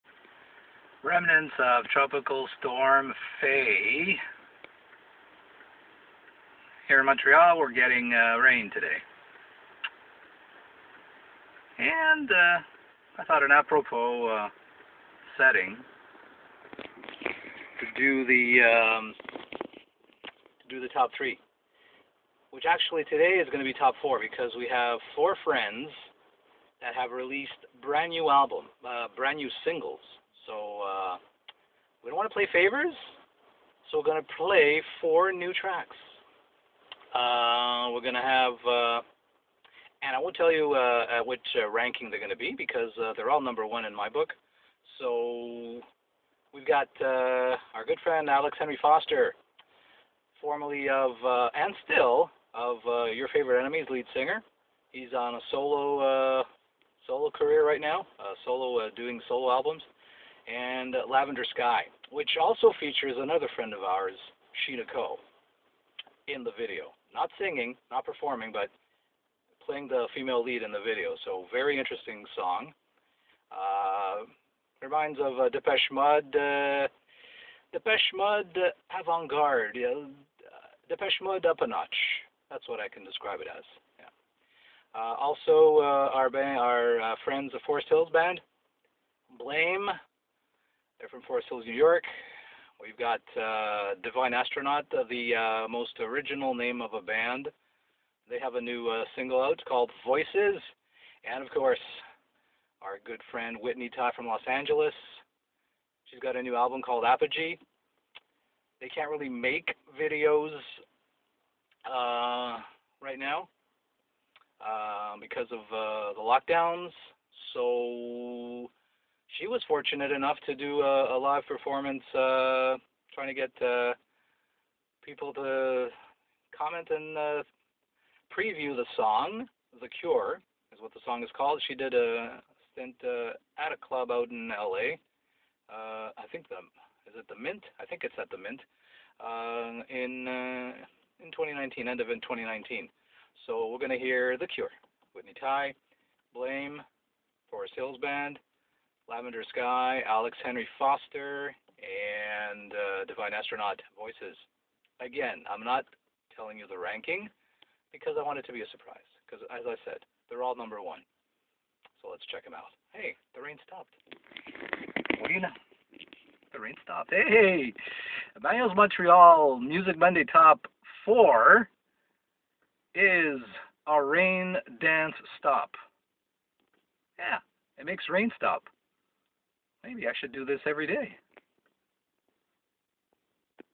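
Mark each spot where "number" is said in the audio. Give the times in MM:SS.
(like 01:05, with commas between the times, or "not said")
00:43, 02:40.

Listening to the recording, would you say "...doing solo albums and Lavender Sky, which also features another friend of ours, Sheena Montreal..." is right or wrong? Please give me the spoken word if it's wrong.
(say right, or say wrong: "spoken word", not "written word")
wrong: "Coe", not "Montreal".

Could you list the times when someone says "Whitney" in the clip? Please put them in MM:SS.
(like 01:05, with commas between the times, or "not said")
01:43, 02:25.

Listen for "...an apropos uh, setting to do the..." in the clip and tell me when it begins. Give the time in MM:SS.
00:13.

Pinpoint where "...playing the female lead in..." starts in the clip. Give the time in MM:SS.
01:09.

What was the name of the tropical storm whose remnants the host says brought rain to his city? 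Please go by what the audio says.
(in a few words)
Faye.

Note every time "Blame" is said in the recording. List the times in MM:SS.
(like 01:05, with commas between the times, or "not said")
01:29, 02:26.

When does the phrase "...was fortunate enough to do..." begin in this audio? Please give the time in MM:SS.
01:59.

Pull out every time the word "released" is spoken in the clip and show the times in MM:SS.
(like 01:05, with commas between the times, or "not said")
00:27.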